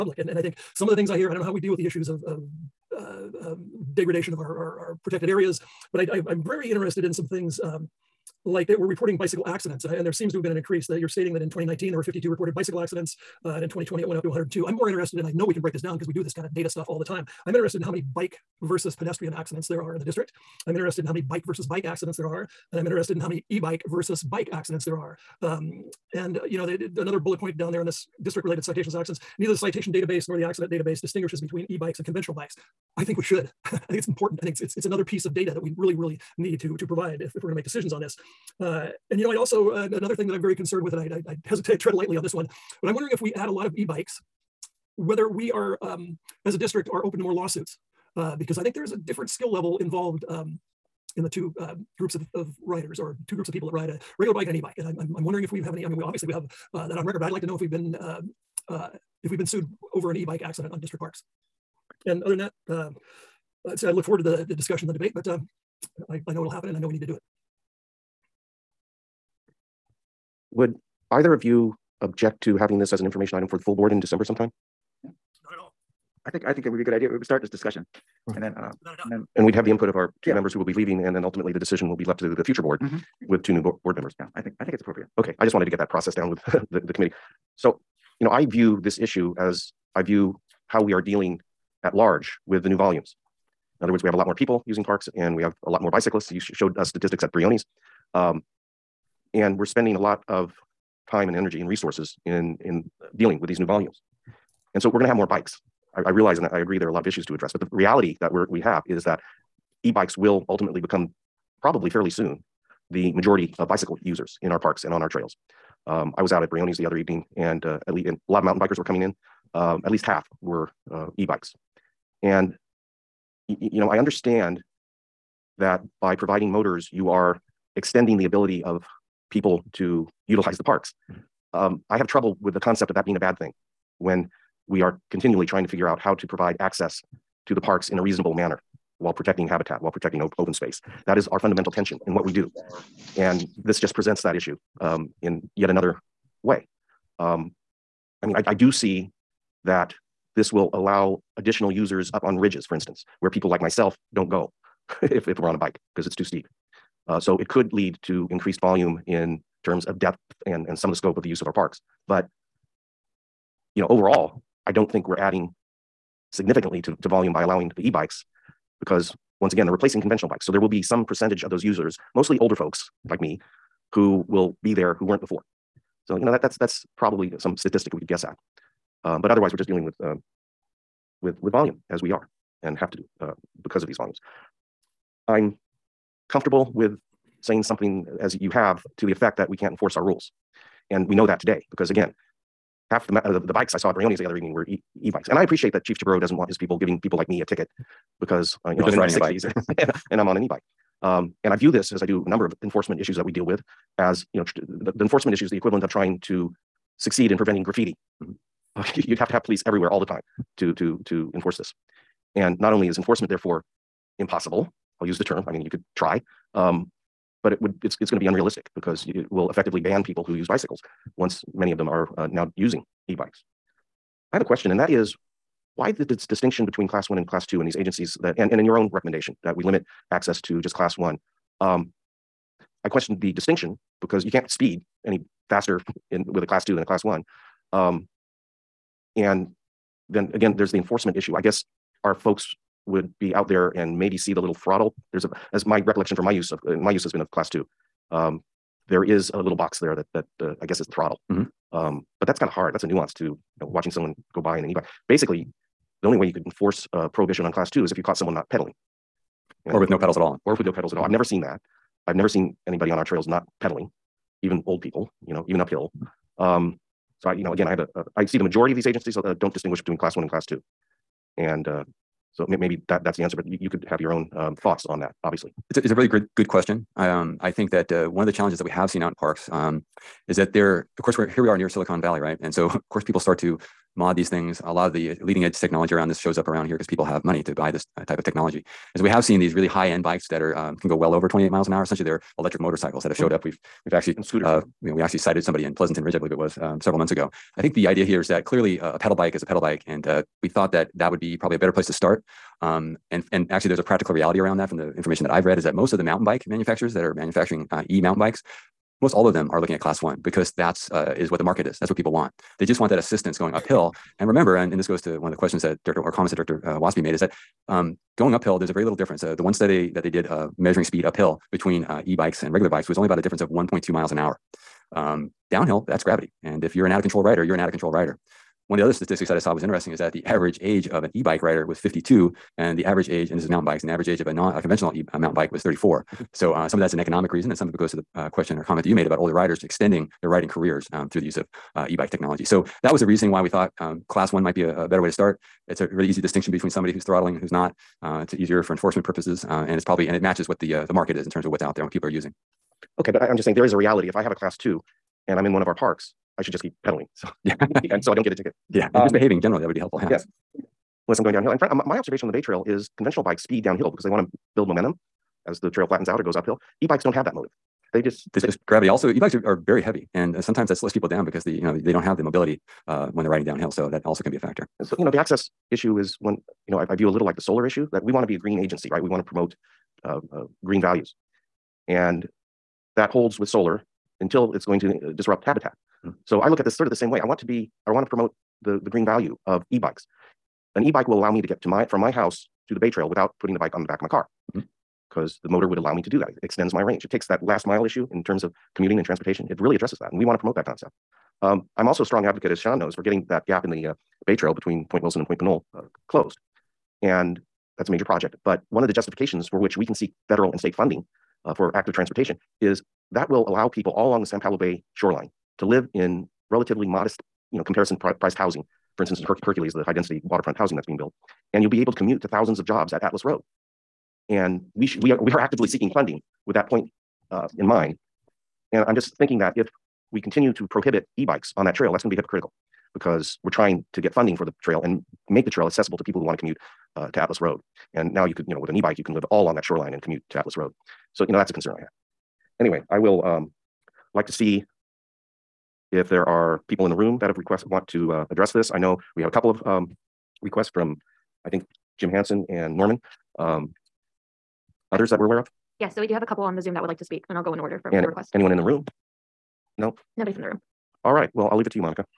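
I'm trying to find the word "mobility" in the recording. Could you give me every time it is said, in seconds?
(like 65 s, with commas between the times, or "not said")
372 s.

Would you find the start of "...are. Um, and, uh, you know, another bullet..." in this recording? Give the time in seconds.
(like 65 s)
24 s.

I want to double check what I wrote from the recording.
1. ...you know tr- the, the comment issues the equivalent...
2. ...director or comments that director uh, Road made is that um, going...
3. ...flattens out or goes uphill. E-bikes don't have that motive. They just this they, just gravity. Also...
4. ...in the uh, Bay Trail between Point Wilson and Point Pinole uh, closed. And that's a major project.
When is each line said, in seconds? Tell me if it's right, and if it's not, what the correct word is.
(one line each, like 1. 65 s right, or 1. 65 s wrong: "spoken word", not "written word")
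1. 204 s wrong: "enforcement", not "comment"
2. 315 s wrong: "Waespi", not "Road"
3. 365 s right
4. 403 s right.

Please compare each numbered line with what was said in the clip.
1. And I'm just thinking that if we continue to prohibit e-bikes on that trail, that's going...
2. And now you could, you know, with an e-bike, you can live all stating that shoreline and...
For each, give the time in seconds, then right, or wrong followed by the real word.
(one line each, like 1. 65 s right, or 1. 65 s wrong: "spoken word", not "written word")
1. 428 s right
2. 437 s wrong: "along", not "stating".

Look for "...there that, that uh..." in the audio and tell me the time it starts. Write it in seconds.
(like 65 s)
249 s.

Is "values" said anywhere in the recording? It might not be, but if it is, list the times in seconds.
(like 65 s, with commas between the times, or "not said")
380 s, 389 s.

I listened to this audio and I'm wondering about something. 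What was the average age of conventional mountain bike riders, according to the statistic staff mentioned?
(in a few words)
34.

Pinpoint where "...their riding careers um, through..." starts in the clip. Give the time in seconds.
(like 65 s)
340 s.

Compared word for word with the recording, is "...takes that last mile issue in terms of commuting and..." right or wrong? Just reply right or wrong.
right.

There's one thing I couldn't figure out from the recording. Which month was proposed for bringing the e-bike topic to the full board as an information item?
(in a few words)
December.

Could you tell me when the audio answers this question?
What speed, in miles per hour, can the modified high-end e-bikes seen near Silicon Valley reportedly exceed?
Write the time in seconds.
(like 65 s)
291 s.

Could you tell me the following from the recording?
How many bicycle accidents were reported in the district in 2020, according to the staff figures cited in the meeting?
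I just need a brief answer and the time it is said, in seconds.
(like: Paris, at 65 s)
102, at 14 s.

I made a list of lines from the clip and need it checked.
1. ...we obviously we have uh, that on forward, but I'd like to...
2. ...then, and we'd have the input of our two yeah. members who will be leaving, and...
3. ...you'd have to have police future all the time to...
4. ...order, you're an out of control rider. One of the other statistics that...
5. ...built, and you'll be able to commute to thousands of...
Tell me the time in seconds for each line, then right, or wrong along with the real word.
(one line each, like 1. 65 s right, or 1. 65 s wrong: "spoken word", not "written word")
1. 55 s wrong: "record", not "forward"
2. 79 s right
3. 208 s wrong: "everywhere", not "future"
4. 327 s wrong: "rider", not "order"
5. 420 s right.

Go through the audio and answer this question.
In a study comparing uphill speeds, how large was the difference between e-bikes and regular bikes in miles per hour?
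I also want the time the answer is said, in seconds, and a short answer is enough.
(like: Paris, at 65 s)
1.2, at 323 s.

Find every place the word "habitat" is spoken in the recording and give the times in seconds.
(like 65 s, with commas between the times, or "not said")
139 s, 385 s.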